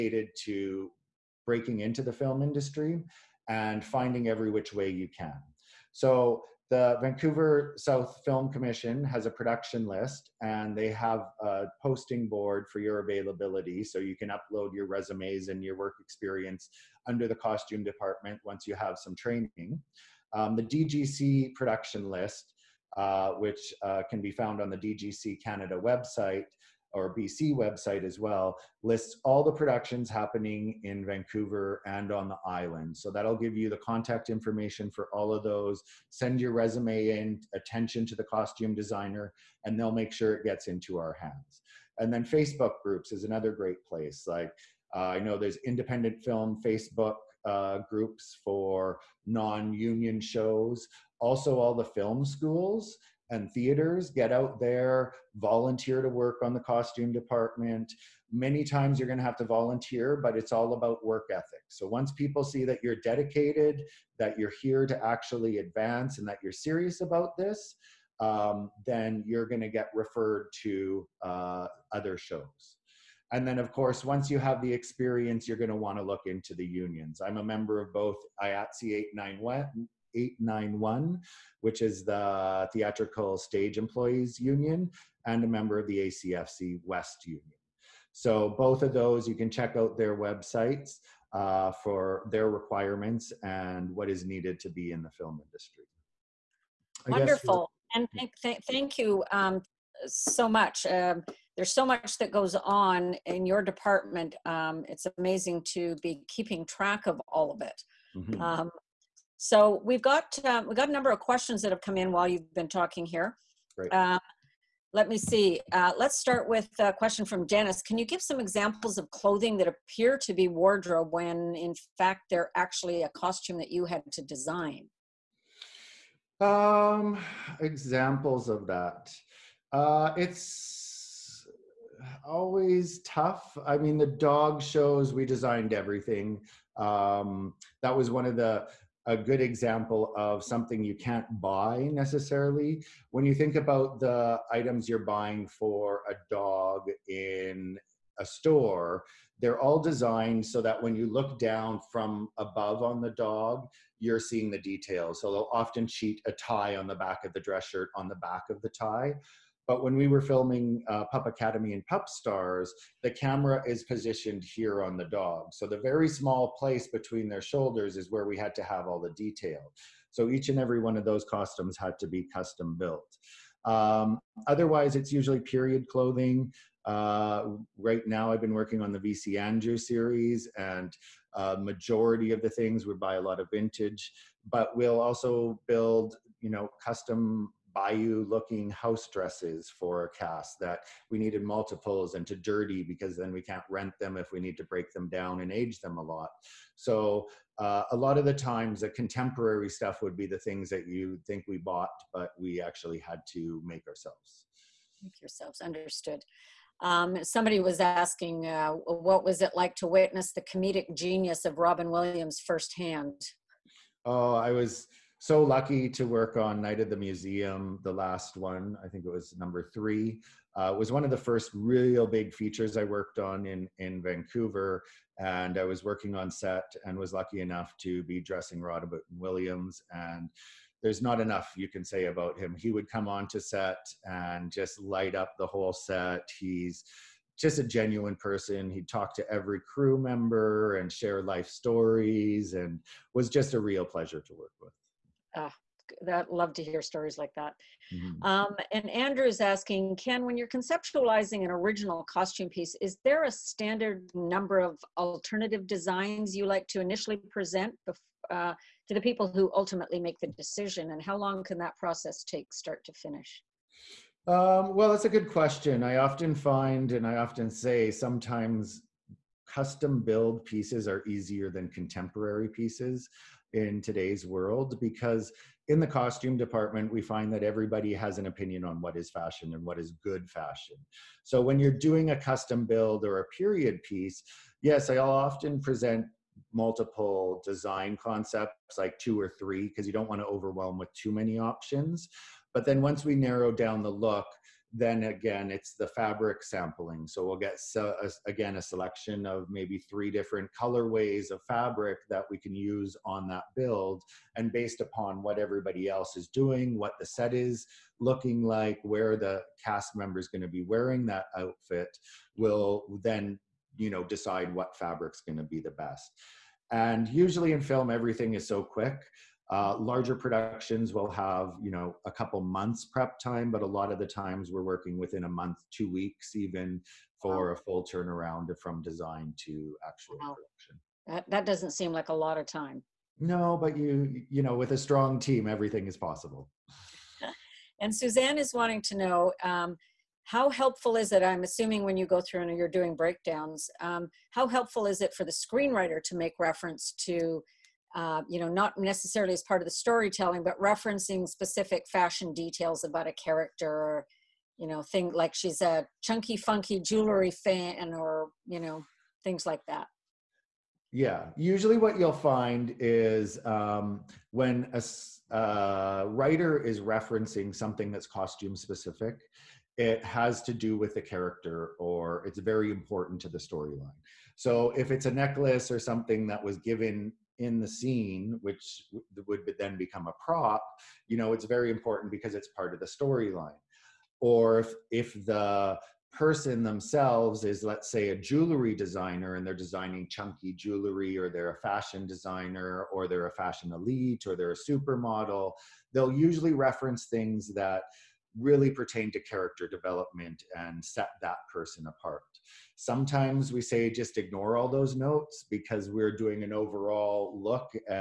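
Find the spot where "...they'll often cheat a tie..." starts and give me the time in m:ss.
2:35.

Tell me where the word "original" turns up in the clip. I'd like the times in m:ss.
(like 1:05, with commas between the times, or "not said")
4:11.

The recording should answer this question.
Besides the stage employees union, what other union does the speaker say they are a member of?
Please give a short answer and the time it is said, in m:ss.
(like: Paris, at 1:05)
ACFC West, at 1:26.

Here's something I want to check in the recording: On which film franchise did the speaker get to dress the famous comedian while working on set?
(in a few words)
Night at the Museum.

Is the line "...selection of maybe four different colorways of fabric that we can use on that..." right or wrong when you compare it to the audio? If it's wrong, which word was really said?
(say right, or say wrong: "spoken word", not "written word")
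wrong: "three", not "four".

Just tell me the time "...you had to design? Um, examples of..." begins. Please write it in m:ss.
2:03.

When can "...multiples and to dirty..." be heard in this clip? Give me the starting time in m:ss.
3:11.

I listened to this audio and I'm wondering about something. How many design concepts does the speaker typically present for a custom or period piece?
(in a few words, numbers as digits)
2 or 3.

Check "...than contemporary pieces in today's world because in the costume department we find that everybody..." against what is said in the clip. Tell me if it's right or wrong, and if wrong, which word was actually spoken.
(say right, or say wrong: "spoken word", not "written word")
right.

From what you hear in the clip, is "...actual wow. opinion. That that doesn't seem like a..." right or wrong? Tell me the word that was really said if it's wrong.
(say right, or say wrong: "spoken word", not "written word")
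wrong: "production", not "opinion".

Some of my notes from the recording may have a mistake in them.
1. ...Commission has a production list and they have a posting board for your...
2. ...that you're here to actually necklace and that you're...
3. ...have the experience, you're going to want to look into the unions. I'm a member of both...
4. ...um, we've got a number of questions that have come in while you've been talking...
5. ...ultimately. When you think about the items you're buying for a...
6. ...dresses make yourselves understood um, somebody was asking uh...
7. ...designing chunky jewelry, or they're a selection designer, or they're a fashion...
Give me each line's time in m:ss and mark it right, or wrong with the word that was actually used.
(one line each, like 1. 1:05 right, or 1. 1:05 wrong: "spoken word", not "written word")
1. 0:08 right
2. 1:04 wrong: "advance", not "necklace"
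3. 1:14 right
4. 1:50 right
5. 2:21 wrong: "necessarily", not "ultimately"
6. 3:23 wrong: "ourselves", not "dresses"
7. 6:29 wrong: "fashion", not "selection".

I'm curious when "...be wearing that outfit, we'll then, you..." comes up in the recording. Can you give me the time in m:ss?
5:10.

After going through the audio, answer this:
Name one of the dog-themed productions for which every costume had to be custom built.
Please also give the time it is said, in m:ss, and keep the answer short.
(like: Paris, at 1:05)
Pup Academy, at 2:41.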